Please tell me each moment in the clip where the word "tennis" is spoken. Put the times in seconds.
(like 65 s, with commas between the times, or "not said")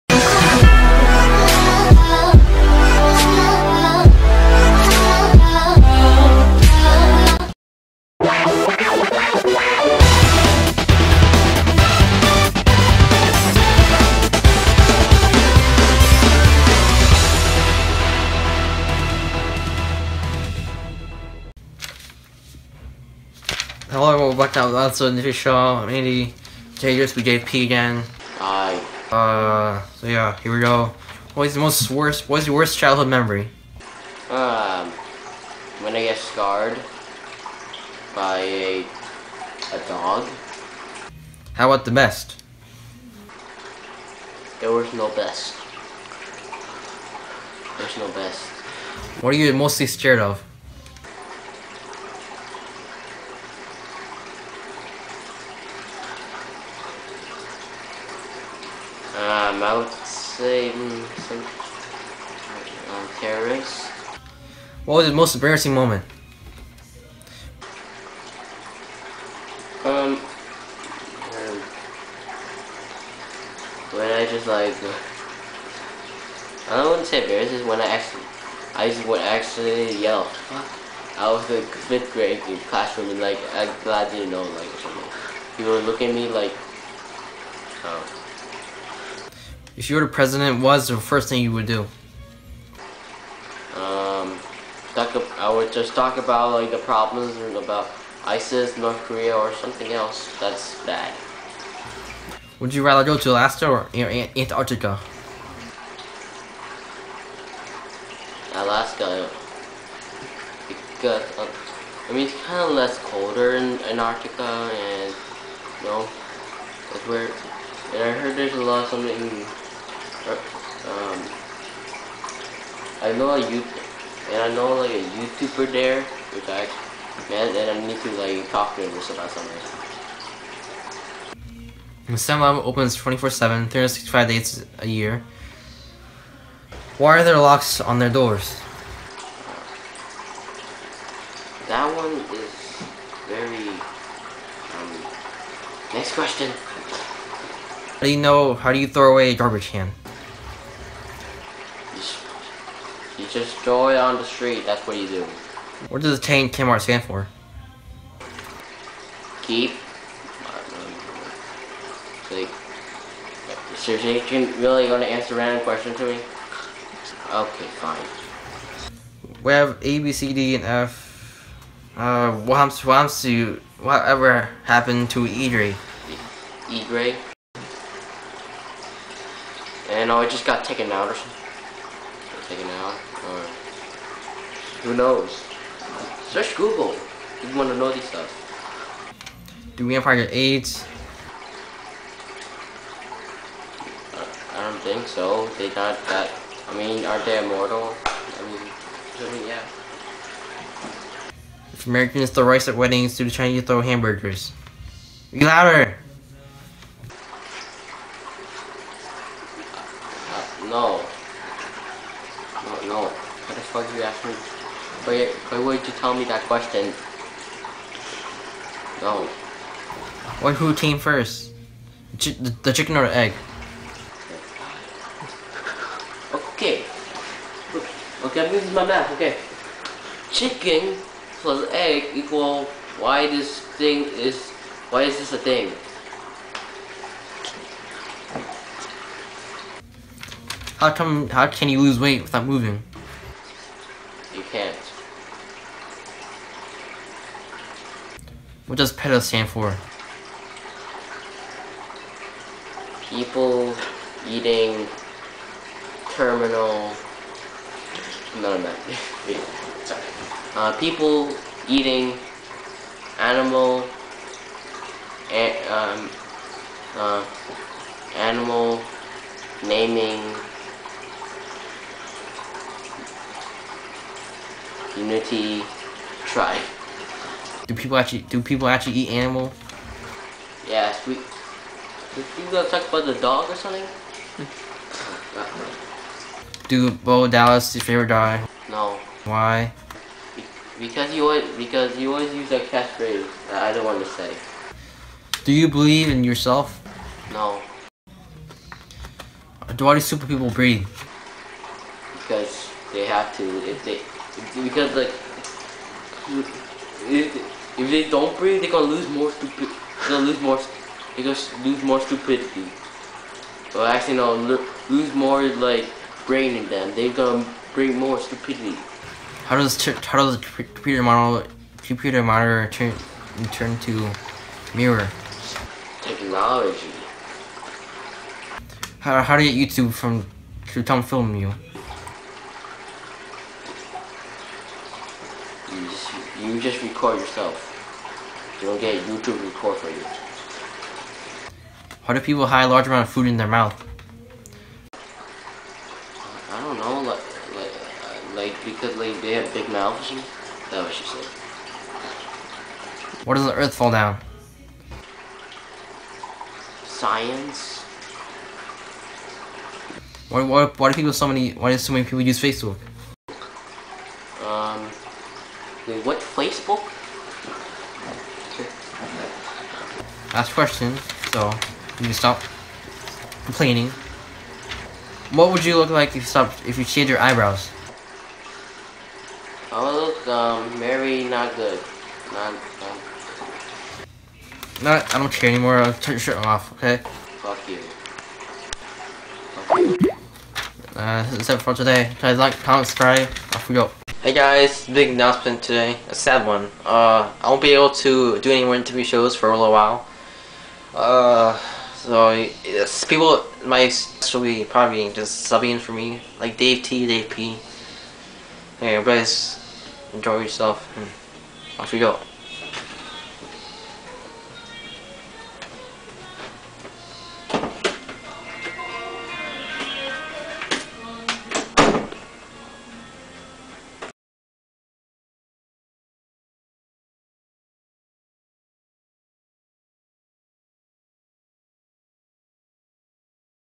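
not said.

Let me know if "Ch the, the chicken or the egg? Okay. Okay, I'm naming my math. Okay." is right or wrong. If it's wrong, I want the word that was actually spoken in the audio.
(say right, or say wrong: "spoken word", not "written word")
wrong: "using", not "naming".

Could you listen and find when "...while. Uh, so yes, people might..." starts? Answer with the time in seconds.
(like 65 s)
399 s.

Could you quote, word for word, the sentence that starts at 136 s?
Why are there locks on their doors?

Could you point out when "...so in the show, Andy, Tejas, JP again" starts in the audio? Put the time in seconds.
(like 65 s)
24 s.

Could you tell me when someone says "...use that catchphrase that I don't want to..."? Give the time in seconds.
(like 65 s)
292 s.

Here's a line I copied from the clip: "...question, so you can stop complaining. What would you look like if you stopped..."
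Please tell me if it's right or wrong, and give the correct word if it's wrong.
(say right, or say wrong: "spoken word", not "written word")
right.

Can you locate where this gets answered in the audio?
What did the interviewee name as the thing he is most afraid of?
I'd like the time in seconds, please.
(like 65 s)
63 s.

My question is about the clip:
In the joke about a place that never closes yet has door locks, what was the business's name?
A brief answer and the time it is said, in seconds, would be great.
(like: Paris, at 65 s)
StemLab, at 132 s.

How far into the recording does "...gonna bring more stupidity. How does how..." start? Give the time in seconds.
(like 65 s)
317 s.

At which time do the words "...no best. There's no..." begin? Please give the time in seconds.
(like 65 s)
44 s.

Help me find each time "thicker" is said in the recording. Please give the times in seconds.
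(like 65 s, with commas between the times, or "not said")
not said.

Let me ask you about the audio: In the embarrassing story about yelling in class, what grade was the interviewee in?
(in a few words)
fifth grade.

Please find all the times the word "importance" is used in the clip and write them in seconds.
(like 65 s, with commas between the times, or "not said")
not said.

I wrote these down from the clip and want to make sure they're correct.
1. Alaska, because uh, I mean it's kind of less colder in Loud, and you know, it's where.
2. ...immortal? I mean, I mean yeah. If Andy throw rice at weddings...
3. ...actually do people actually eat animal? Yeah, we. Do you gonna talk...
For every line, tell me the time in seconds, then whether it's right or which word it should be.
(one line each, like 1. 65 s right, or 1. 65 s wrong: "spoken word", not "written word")
1. 108 s wrong: "Antarctica", not "Loud"
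2. 197 s wrong: "Americans", not "Andy"
3. 277 s right.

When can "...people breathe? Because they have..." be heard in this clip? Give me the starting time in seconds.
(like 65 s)
300 s.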